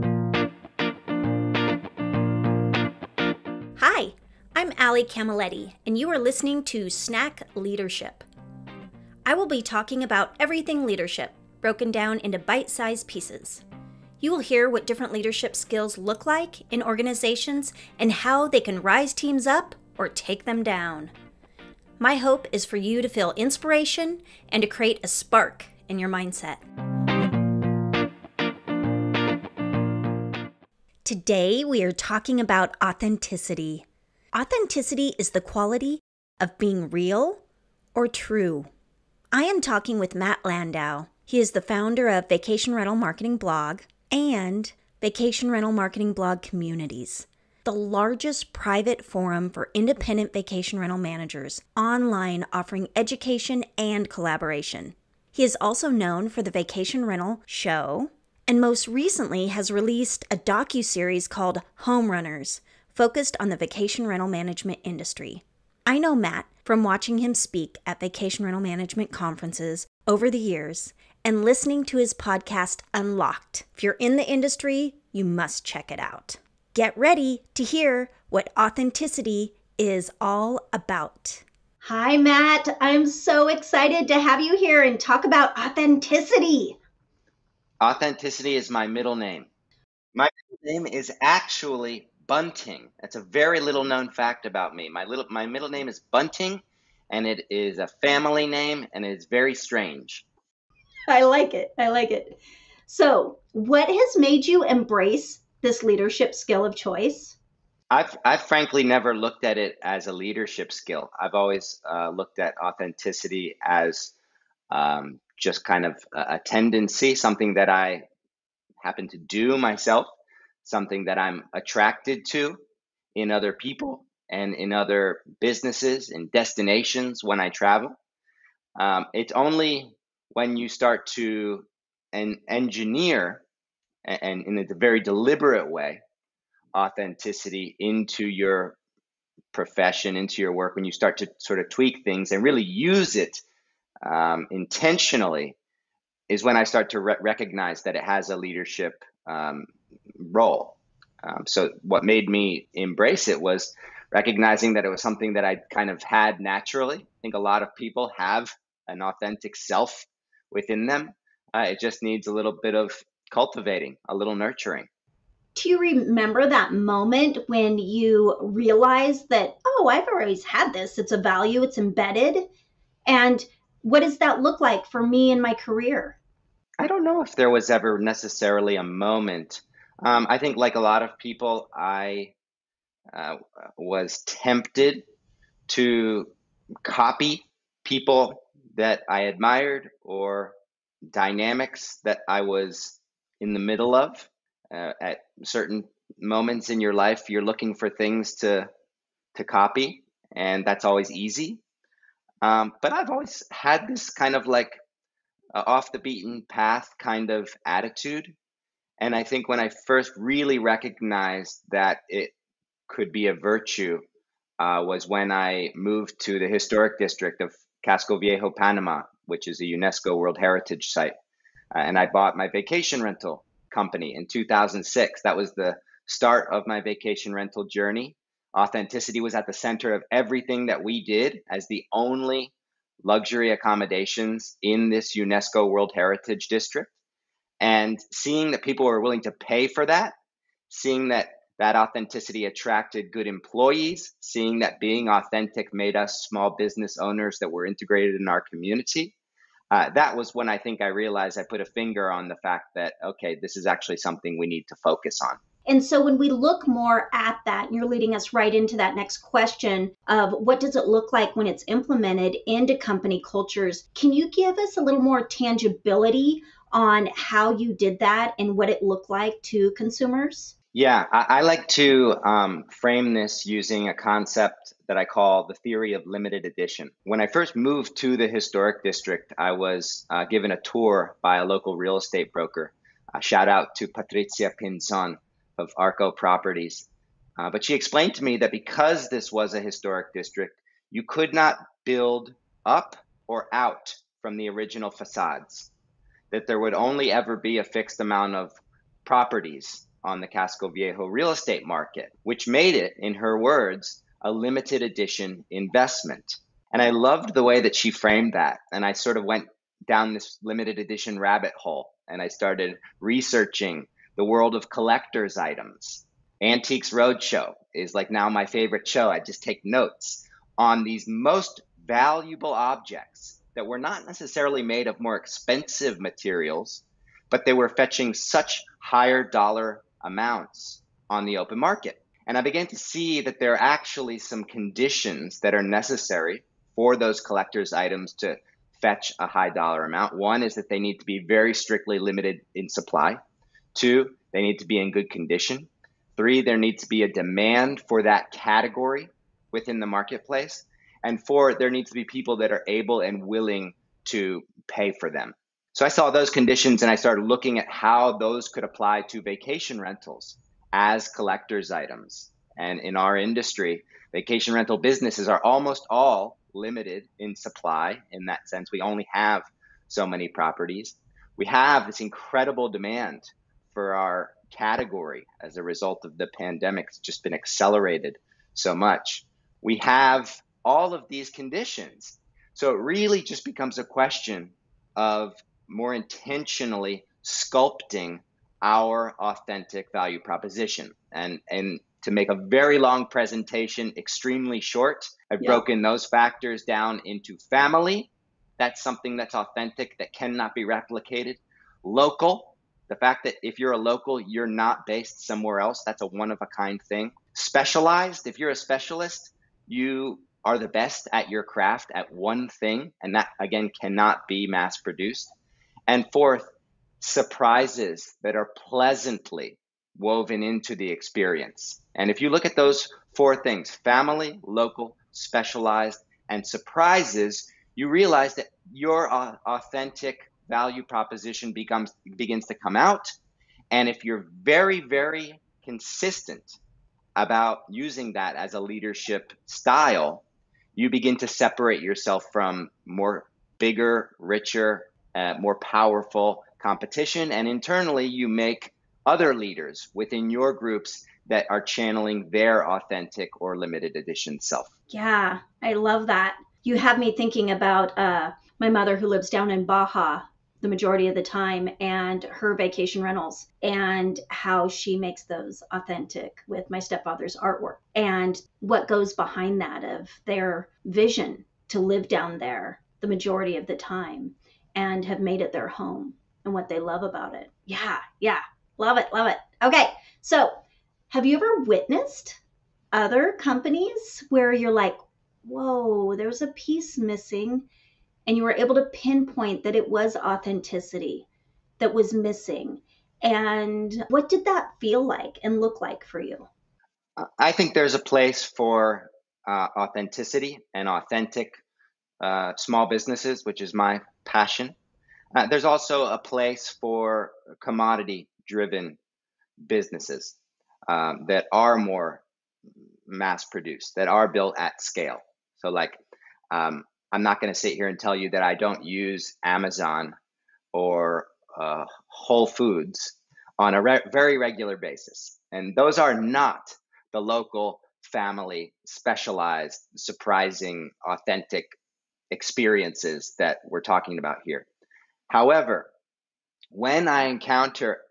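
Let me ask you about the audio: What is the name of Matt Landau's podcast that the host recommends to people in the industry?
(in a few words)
Unlocked.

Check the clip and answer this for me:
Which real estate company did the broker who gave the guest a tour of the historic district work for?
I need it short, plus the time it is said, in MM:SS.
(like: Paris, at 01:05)
Arco Properties, at 04:45.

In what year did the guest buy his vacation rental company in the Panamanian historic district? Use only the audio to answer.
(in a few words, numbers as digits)
2006.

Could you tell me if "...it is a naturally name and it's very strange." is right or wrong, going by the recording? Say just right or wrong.
wrong.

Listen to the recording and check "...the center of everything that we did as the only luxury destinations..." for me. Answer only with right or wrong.
wrong.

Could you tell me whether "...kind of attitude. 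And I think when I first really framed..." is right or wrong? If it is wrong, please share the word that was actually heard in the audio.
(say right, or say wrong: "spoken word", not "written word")
wrong: "recognized", not "framed".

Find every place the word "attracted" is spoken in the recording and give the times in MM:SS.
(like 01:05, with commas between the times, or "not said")
02:01, 04:02.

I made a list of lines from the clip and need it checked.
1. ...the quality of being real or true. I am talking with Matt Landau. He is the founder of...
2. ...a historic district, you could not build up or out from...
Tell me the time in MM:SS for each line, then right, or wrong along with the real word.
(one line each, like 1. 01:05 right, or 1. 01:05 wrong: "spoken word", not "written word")
1. 00:35 right
2. 04:49 right.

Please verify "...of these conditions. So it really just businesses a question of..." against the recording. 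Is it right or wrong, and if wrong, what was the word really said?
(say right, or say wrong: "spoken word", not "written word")
wrong: "becomes", not "businesses".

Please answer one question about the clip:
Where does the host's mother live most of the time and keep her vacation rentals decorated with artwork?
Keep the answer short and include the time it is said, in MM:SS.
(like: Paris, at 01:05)
Baja, at 07:39.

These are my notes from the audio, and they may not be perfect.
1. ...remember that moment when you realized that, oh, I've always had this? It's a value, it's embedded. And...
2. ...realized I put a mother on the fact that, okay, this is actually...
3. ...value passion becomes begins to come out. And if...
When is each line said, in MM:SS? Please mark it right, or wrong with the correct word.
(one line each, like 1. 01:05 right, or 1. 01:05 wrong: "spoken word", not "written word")
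1. 02:45 right
2. 04:10 wrong: "finger", not "mother"
3. 07:10 wrong: "proposition", not "passion".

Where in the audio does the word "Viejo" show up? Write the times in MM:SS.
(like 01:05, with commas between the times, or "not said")
03:38, 05:00.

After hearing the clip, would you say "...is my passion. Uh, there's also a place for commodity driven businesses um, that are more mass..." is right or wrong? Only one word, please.
right.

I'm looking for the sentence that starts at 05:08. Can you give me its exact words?
And I sort of went down this limited edition rabbit hole and I started researching the world of collectors items.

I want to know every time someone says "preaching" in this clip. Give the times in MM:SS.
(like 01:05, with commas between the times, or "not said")
not said.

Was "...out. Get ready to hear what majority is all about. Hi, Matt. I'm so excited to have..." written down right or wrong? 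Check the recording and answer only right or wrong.
wrong.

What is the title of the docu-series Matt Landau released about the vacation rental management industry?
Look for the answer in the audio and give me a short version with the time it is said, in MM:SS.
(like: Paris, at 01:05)
Home Runners, at 01:01.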